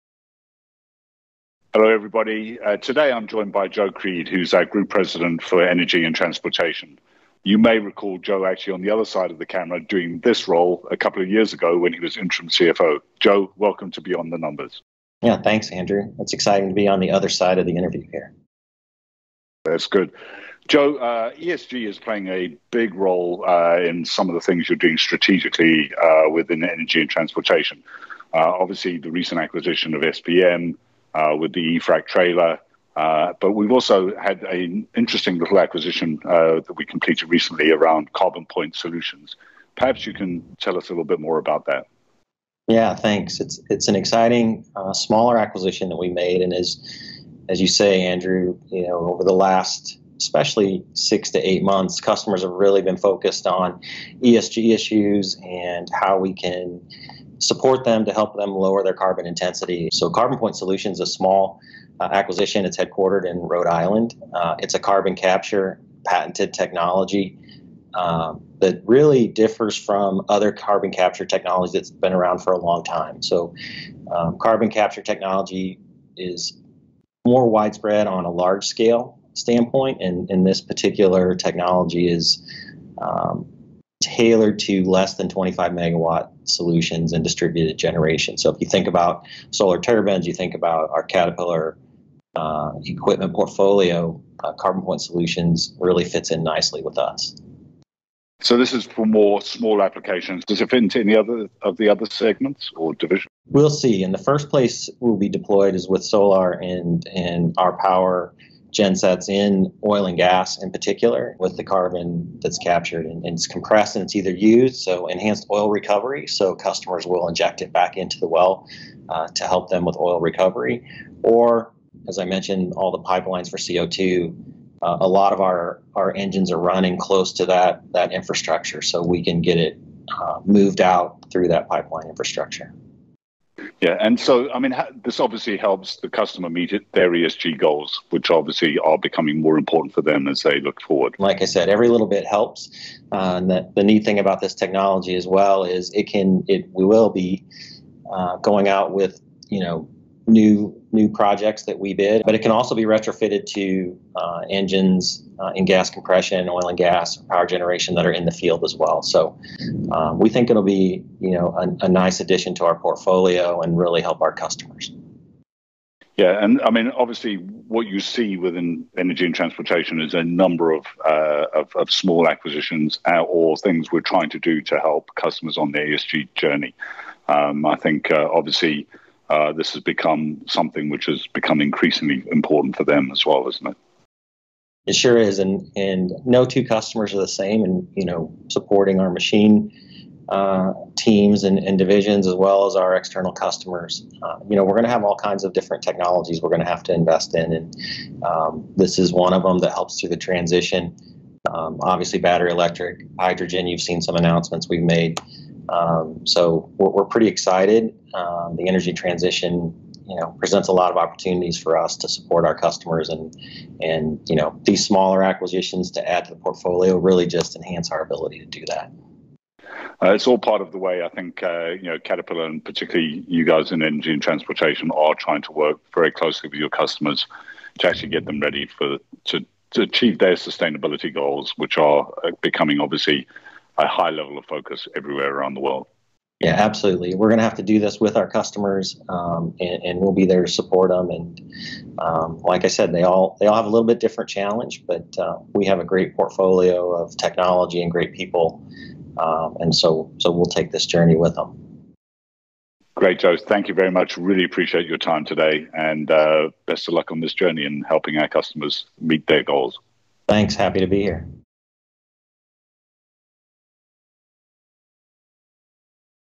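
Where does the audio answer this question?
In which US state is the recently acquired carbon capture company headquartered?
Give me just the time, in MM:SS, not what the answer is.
01:03.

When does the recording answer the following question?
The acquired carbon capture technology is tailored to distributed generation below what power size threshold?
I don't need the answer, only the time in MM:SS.
01:25.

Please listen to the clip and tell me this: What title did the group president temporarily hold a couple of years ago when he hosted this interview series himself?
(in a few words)
interim CFO.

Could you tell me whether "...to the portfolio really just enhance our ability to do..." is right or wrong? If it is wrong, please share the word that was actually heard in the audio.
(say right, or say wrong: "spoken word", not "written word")
right.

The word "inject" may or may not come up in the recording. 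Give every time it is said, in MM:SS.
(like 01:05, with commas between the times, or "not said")
01:57.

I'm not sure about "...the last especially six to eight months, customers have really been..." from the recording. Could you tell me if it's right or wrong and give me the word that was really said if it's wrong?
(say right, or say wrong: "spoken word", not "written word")
right.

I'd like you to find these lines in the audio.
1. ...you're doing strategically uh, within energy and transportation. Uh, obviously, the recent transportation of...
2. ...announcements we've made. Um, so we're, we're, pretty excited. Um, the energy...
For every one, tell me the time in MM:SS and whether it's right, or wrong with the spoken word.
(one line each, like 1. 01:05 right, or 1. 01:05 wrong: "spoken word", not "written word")
1. 00:24 wrong: "acquisition", not "transportation"
2. 03:24 right.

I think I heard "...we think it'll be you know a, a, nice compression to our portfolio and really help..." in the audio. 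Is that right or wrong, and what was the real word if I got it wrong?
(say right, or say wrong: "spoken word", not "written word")
wrong: "addition", not "compression".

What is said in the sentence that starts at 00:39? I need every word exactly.
Perhaps you can tell us a little bit more about that.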